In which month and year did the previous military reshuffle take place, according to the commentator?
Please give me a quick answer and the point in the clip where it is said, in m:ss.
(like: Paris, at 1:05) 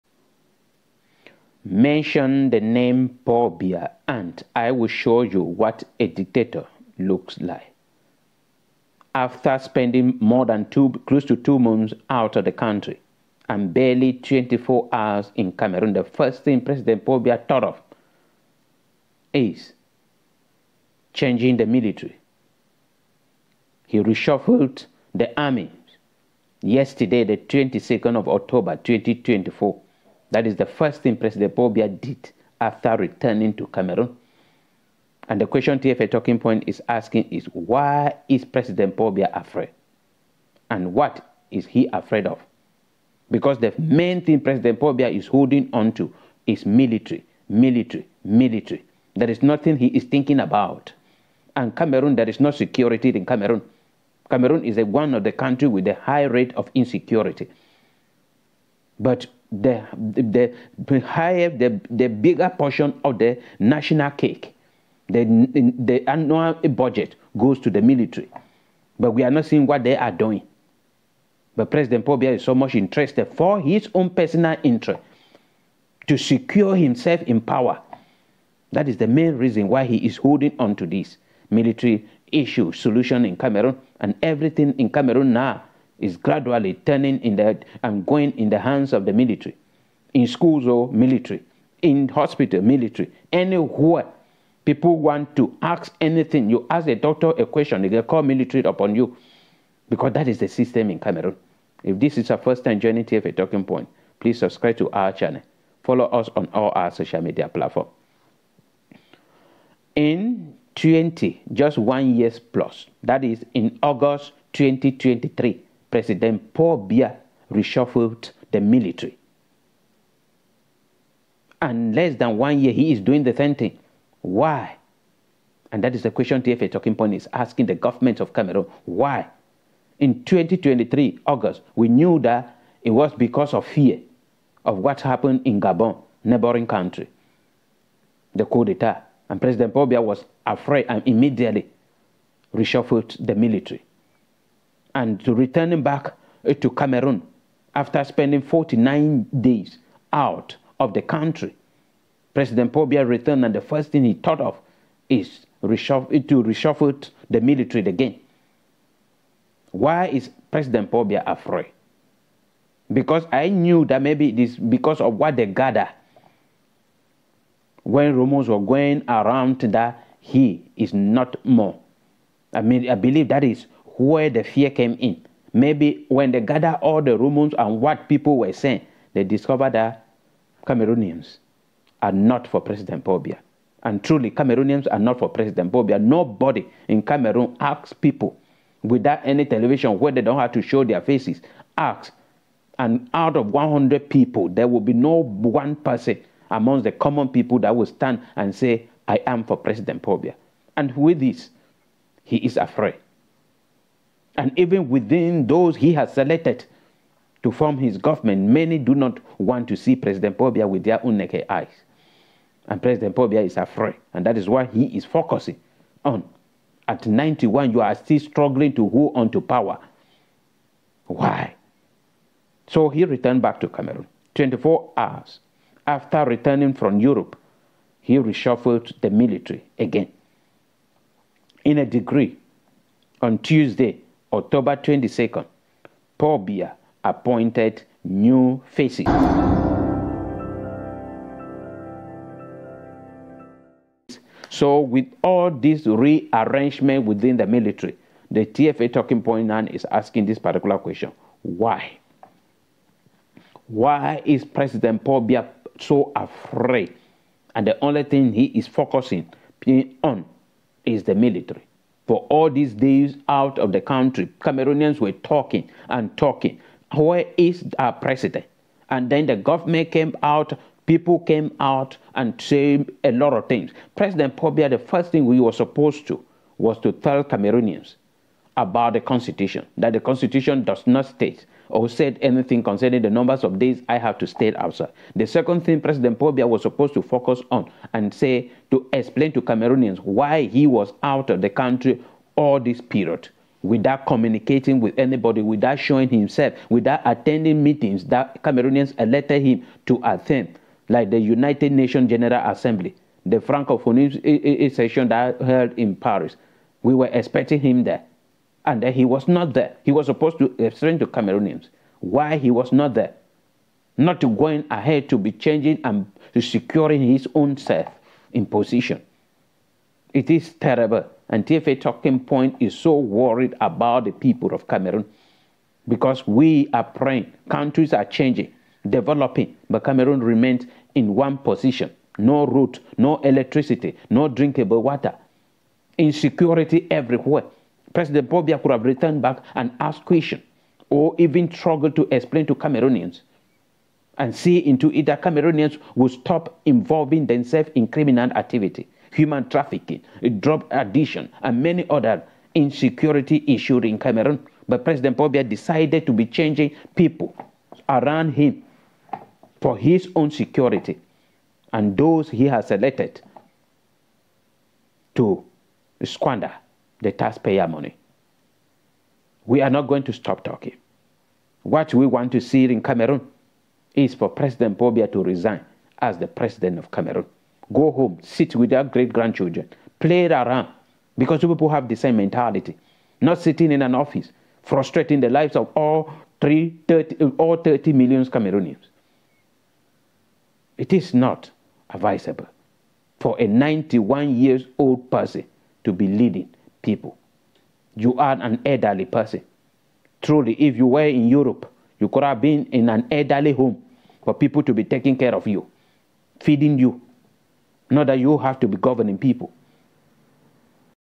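August 2023, at 1:53.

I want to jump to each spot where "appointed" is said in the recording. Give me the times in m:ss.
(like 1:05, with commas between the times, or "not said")
3:57.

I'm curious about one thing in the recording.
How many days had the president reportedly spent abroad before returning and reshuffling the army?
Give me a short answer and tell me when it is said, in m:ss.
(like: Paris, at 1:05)
49, at 2:28.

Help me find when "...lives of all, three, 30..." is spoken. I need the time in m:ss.
6:25.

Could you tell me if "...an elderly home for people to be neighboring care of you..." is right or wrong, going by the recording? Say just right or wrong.
wrong.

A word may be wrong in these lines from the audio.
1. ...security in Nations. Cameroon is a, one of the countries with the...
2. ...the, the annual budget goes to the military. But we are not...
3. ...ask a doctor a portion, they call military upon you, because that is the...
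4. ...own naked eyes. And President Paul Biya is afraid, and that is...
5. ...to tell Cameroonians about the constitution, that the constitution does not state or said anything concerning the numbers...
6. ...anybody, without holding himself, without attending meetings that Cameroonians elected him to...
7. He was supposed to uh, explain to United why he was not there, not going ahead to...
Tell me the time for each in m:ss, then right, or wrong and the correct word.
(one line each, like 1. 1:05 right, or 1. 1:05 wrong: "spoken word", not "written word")
1. 0:52 wrong: "Cameroon", not "Nations"
2. 1:05 right
3. 1:36 wrong: "question", not "portion"
4. 3:31 right
5. 4:36 right
6. 4:54 wrong: "showing", not "holding"
7. 5:09 wrong: "Cameroonians", not "United".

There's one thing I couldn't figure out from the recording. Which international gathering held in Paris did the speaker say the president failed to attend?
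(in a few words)
Francophone session.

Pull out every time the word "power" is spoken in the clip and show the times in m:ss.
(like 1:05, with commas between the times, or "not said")
1:17, 3:39.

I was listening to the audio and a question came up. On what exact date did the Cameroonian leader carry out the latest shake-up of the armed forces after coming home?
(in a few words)
22 October 2024.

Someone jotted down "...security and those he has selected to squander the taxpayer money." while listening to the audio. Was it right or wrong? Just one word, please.
right.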